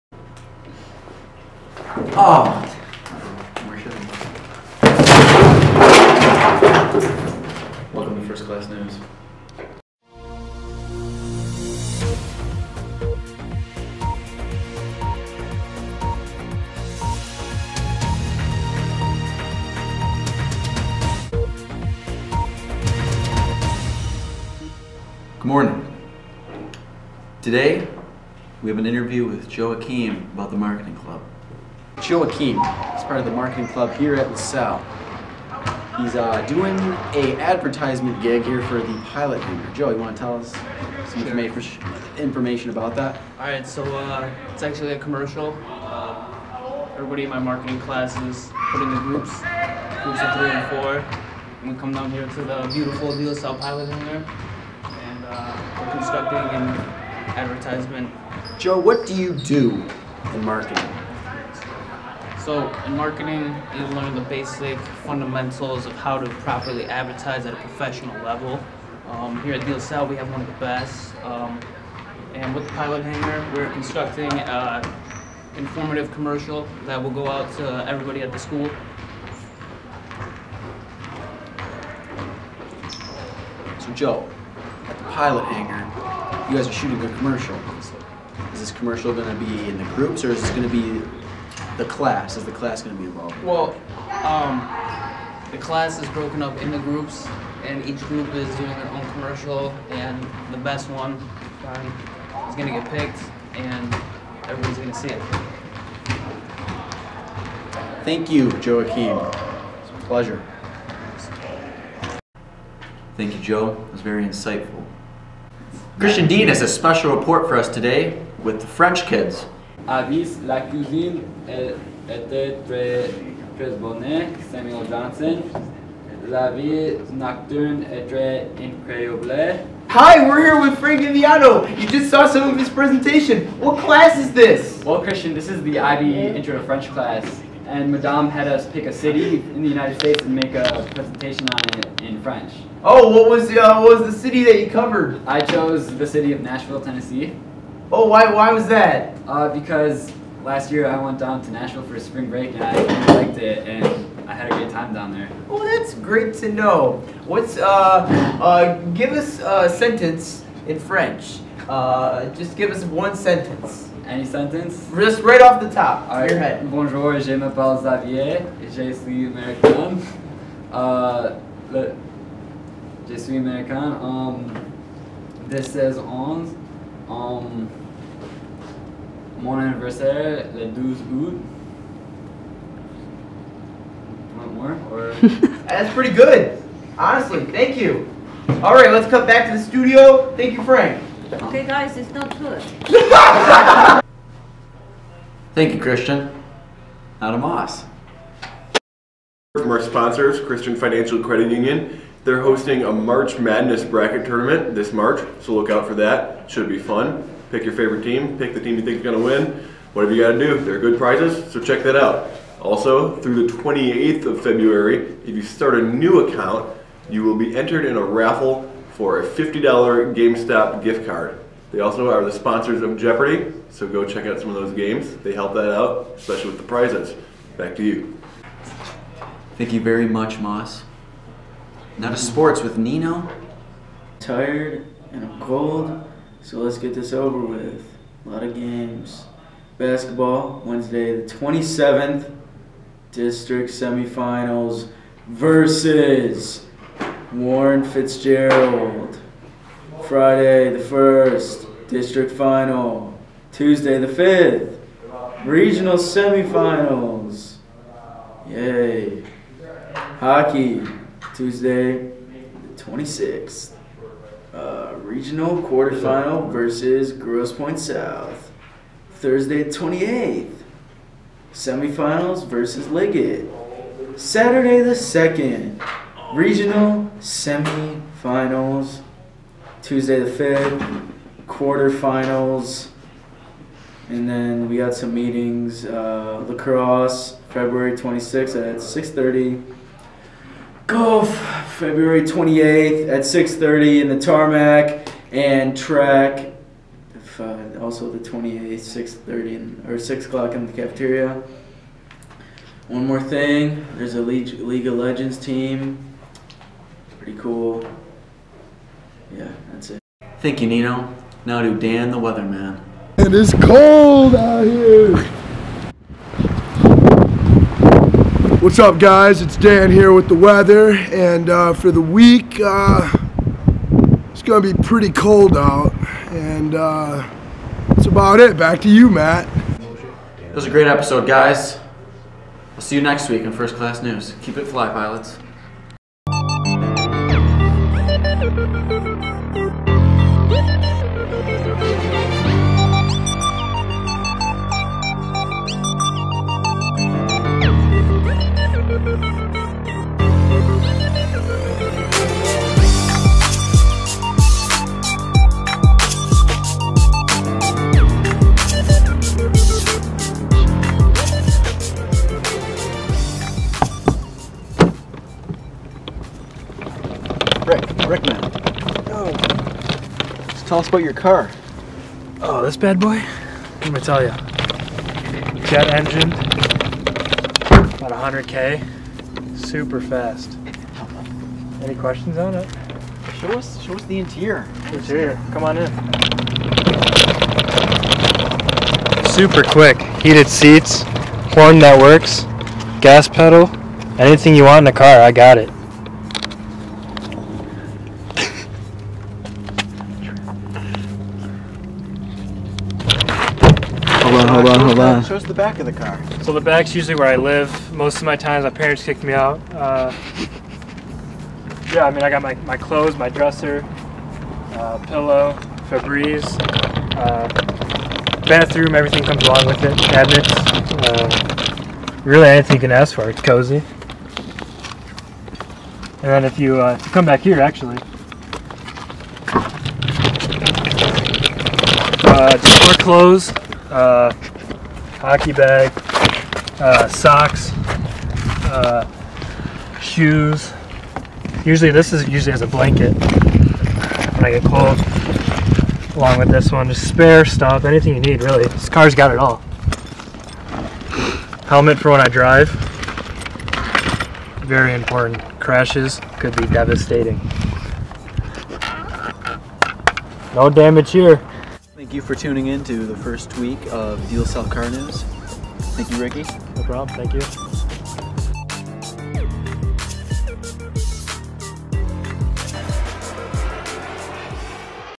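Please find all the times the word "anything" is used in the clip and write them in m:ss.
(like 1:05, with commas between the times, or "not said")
6:34, 7:02, 7:27.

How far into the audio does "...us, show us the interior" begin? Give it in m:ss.
6:23.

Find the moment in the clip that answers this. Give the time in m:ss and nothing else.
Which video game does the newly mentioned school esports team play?
5:04.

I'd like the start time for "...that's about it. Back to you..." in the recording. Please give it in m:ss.
5:27.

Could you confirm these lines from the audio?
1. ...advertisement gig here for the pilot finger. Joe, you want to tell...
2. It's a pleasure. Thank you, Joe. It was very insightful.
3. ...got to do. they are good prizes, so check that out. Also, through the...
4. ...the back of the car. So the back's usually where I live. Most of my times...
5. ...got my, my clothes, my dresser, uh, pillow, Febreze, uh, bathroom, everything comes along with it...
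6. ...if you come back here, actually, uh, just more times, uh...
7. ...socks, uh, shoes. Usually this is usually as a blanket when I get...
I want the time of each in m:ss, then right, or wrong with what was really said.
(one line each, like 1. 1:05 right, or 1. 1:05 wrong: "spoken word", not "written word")
1. 0:37 right
2. 1:49 right
3. 3:30 right
4. 6:45 right
5. 6:52 right
6. 7:06 wrong: "clothes", not "times"
7. 7:17 right.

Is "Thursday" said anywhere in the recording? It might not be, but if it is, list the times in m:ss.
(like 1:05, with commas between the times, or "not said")
4:29.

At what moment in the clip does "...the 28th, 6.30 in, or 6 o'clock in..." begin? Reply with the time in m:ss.
4:58.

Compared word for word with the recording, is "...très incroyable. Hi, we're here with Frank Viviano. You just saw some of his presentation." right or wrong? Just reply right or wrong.
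right.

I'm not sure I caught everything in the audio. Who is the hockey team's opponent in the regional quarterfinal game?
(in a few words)
Grosse Pointe South.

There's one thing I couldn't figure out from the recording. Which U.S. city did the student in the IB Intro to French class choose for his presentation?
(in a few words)
Nashville, Tennessee.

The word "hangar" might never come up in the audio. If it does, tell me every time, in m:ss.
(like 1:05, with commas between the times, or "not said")
0:53, 1:13, 1:25.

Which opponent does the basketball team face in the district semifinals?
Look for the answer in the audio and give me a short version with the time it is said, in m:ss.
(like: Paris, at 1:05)
Warren Fitzgerald, at 4:07.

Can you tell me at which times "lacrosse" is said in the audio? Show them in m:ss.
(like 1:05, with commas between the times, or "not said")
4:46.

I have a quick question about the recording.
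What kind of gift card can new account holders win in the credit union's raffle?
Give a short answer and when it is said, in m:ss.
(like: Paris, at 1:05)
GameStop, at 3:40.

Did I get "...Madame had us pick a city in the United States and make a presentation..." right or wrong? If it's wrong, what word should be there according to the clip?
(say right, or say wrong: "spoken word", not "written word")
right.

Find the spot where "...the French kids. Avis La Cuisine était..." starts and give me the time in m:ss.
1:58.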